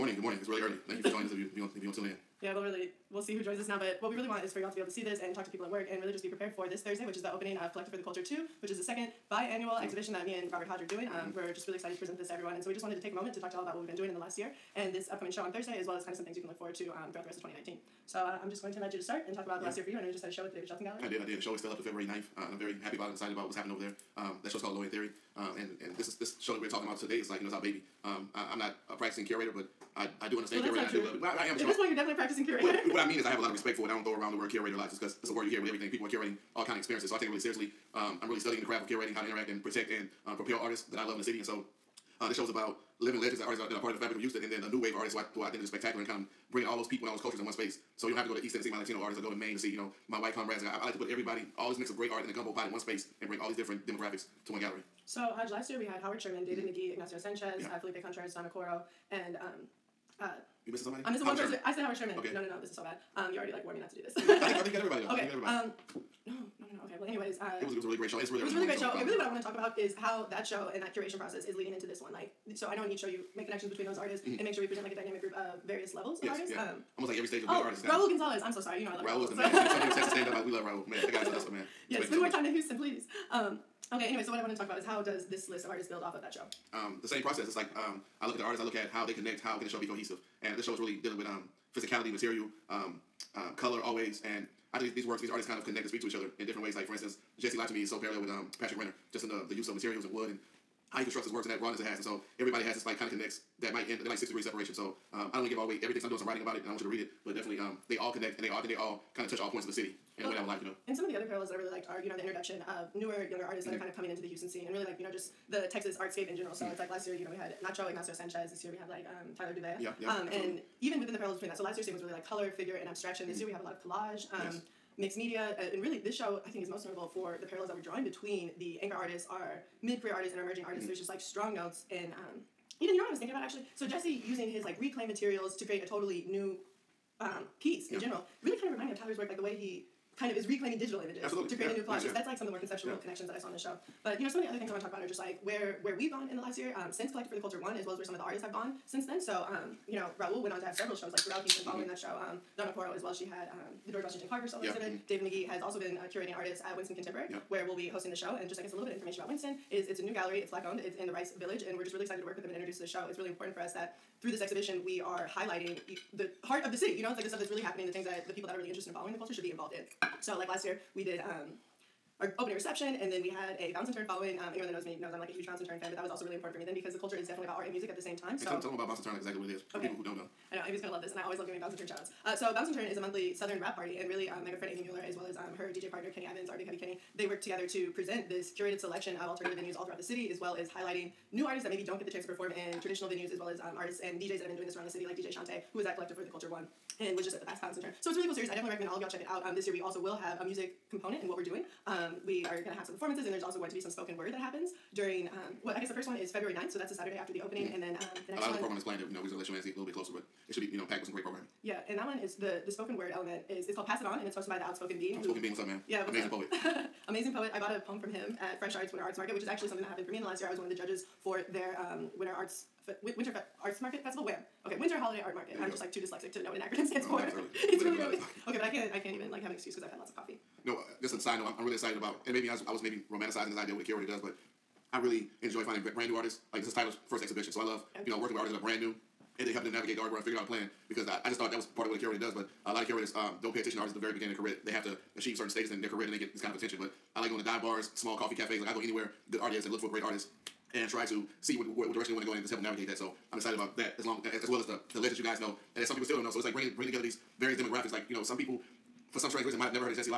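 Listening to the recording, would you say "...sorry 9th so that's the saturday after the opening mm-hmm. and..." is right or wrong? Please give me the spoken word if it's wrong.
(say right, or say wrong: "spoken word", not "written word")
wrong: "february", not "sorry".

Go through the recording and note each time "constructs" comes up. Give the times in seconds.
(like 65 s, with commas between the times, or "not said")
101 s.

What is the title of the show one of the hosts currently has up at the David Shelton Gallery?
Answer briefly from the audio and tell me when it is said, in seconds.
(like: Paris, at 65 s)
A Theory, at 24 s.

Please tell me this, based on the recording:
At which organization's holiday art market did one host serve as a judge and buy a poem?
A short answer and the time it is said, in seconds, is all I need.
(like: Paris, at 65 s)
Fresh Arts, at 218 s.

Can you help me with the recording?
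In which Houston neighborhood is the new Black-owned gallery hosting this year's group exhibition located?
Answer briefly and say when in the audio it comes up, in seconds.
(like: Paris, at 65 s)
Rice Village, at 161 s.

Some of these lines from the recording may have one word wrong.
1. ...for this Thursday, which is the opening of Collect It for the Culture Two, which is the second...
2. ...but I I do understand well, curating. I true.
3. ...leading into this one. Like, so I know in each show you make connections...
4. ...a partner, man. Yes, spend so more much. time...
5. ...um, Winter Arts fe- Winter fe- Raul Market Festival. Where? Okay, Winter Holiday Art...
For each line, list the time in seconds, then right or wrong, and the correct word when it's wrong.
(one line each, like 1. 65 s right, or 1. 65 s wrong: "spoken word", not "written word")
1. 6 s right
2. 29 s right
3. 71 s right
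4. 81 s wrong: "hustler", not "partner"
5. 221 s wrong: "Arts", not "Raul".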